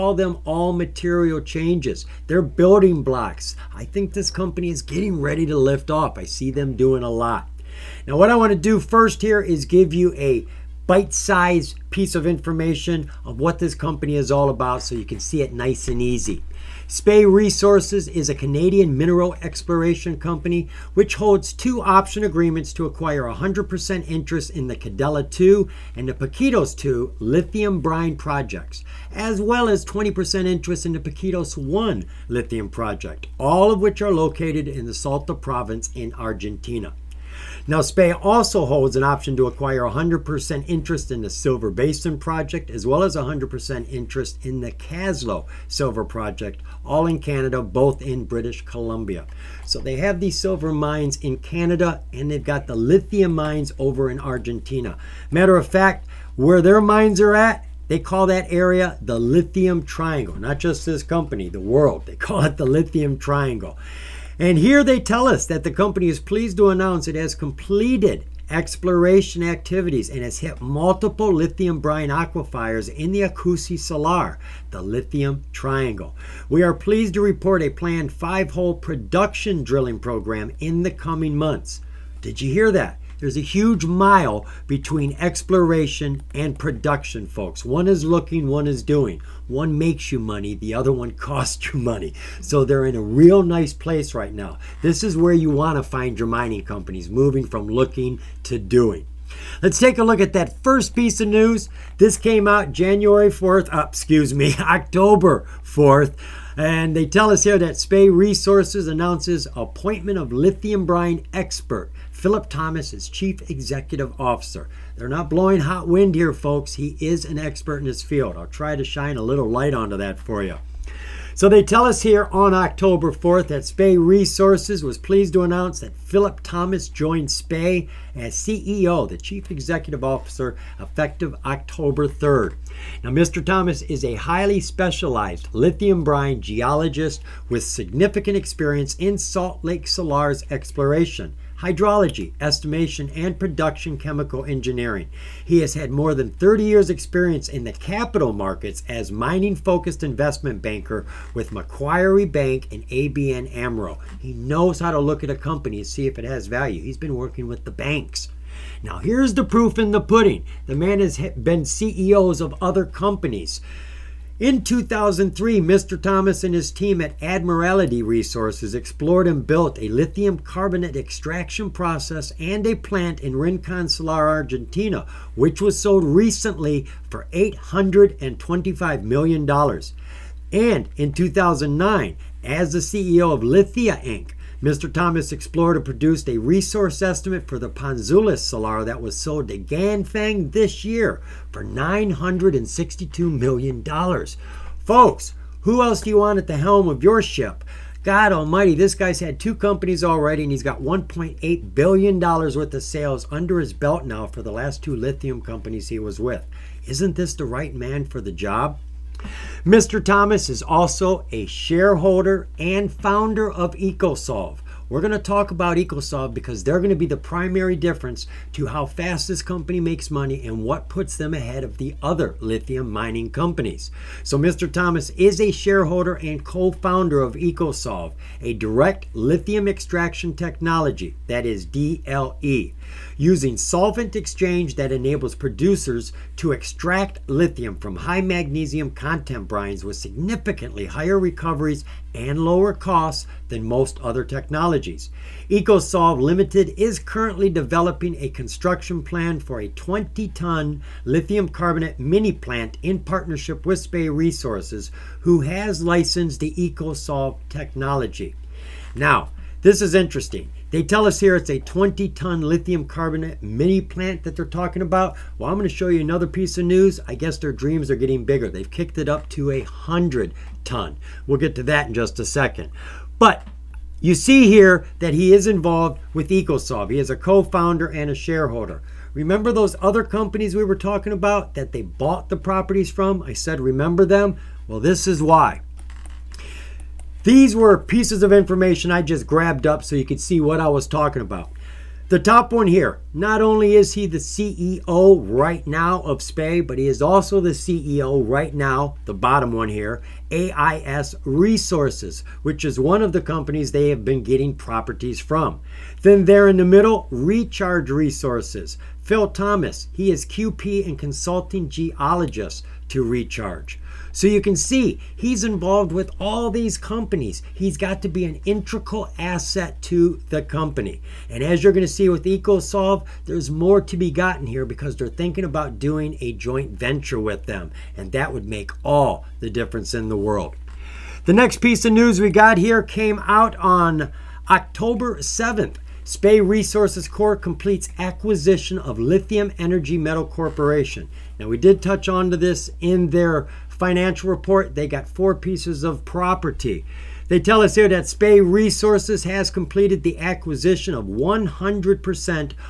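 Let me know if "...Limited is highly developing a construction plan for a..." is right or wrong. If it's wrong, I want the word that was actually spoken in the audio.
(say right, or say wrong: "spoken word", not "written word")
wrong: "currently", not "highly".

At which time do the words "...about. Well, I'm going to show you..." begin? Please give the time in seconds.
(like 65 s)
264 s.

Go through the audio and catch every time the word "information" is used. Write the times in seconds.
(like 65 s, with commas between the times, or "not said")
12 s, 288 s.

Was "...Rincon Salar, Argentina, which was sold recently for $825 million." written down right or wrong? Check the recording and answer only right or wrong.
right.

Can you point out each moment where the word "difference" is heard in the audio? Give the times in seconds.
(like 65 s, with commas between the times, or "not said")
217 s, 329 s.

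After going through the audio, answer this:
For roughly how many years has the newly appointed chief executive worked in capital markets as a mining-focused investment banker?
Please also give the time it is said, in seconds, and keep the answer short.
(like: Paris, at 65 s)
30, at 146 s.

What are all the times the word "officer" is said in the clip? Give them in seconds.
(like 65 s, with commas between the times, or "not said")
114 s, 130 s.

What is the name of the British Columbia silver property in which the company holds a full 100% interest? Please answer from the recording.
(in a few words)
Kaslo Silver Project.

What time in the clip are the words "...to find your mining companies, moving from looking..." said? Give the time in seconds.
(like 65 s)
95 s.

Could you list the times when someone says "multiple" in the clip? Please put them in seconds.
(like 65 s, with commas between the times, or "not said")
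70 s.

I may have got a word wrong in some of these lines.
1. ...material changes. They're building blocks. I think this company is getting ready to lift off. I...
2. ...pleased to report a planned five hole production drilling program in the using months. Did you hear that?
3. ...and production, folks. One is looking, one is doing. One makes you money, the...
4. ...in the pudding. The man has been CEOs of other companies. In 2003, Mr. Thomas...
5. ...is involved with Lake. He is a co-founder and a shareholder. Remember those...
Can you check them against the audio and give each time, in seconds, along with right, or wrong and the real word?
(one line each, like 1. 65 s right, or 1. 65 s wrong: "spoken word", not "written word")
1. 0 s right
2. 76 s wrong: "coming", not "using"
3. 86 s right
4. 159 s right
5. 275 s wrong: "Ekosolve", not "Lake".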